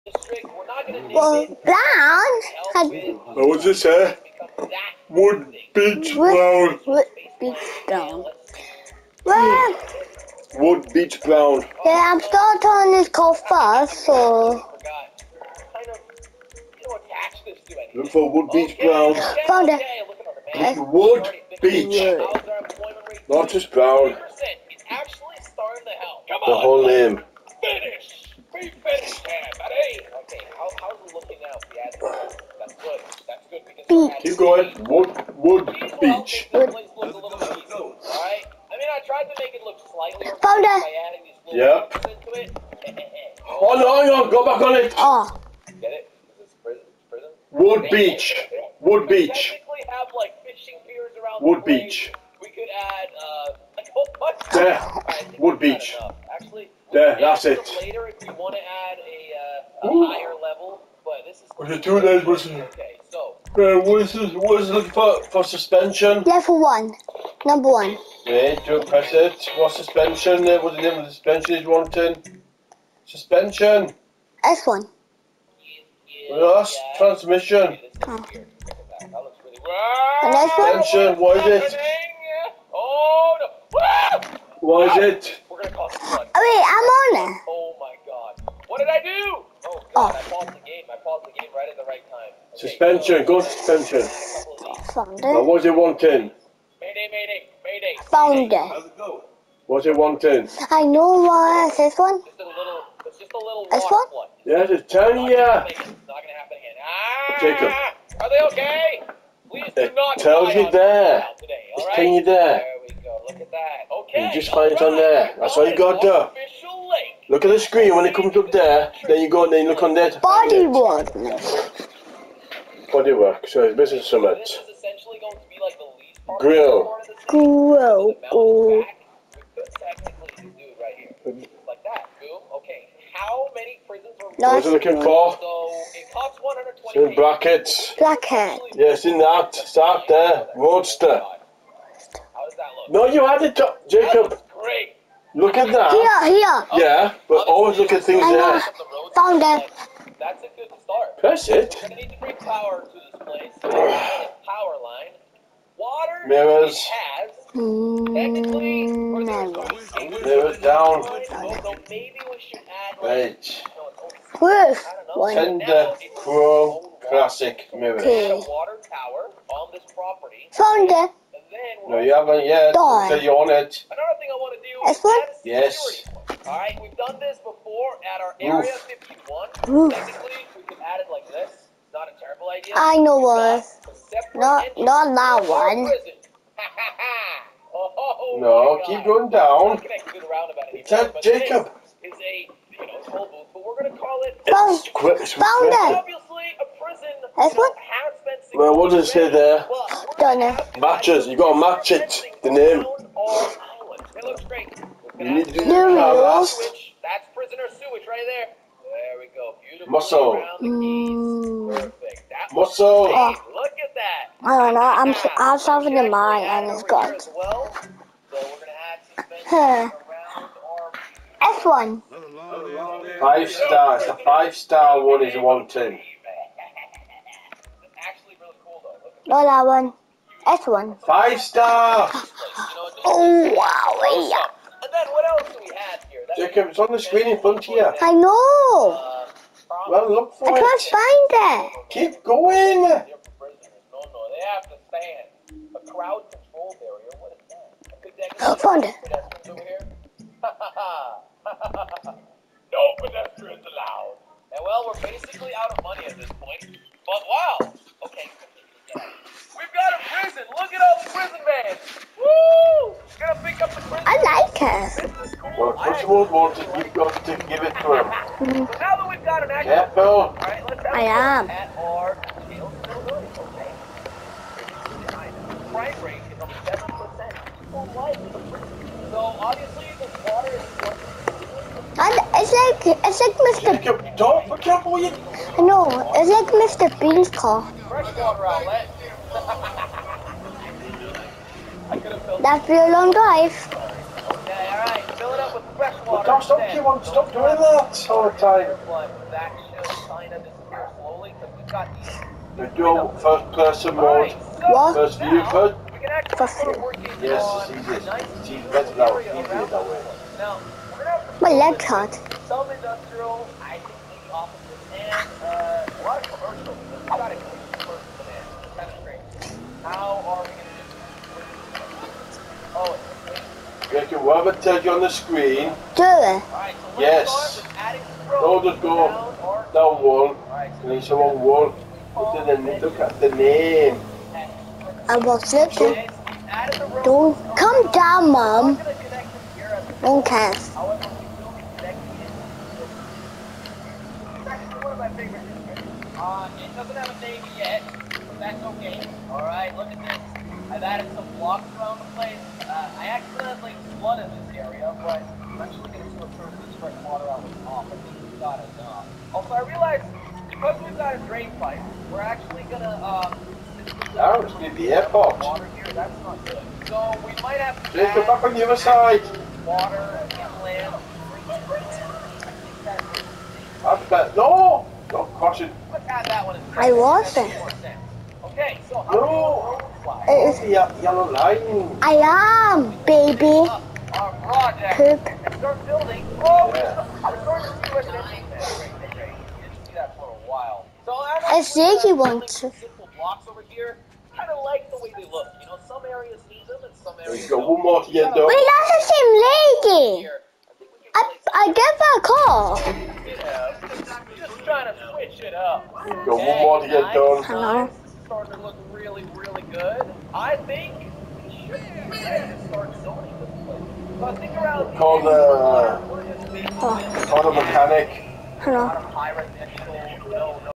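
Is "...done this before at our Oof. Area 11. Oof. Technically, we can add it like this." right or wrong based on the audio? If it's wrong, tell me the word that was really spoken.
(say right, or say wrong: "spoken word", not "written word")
wrong: "51", not "11".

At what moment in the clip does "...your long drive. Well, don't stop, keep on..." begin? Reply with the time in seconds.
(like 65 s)
292 s.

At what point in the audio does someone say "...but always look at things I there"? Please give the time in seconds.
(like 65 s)
147 s.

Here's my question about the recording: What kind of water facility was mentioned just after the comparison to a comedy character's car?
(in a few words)
Freshwater outlet.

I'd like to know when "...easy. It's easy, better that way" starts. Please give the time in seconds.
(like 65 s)
307 s.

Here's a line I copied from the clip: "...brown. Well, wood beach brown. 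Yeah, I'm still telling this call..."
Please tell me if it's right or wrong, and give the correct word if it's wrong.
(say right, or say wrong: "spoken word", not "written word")
right.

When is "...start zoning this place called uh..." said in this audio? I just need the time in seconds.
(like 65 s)
412 s.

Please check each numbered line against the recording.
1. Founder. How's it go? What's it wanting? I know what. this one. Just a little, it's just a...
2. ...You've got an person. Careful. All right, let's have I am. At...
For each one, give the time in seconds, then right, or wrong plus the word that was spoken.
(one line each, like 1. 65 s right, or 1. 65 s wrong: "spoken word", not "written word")
1. 98 s right
2. 269 s wrong: "action", not "person".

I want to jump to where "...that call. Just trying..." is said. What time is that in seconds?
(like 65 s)
401 s.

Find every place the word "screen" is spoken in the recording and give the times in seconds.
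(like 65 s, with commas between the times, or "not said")
117 s, 236 s, 325 s.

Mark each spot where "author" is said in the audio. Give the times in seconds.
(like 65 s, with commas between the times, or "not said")
not said.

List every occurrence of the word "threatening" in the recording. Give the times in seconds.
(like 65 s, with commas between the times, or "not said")
not said.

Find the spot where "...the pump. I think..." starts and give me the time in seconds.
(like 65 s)
357 s.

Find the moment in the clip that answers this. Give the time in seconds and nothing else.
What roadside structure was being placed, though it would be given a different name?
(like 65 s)
193 s.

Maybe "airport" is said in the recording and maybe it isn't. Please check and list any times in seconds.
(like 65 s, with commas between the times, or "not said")
364 s.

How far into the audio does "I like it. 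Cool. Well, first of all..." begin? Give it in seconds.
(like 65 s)
264 s.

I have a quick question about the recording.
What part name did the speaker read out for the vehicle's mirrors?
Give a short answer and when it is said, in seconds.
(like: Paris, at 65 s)
Chrome Classic Mirrors, at 166 s.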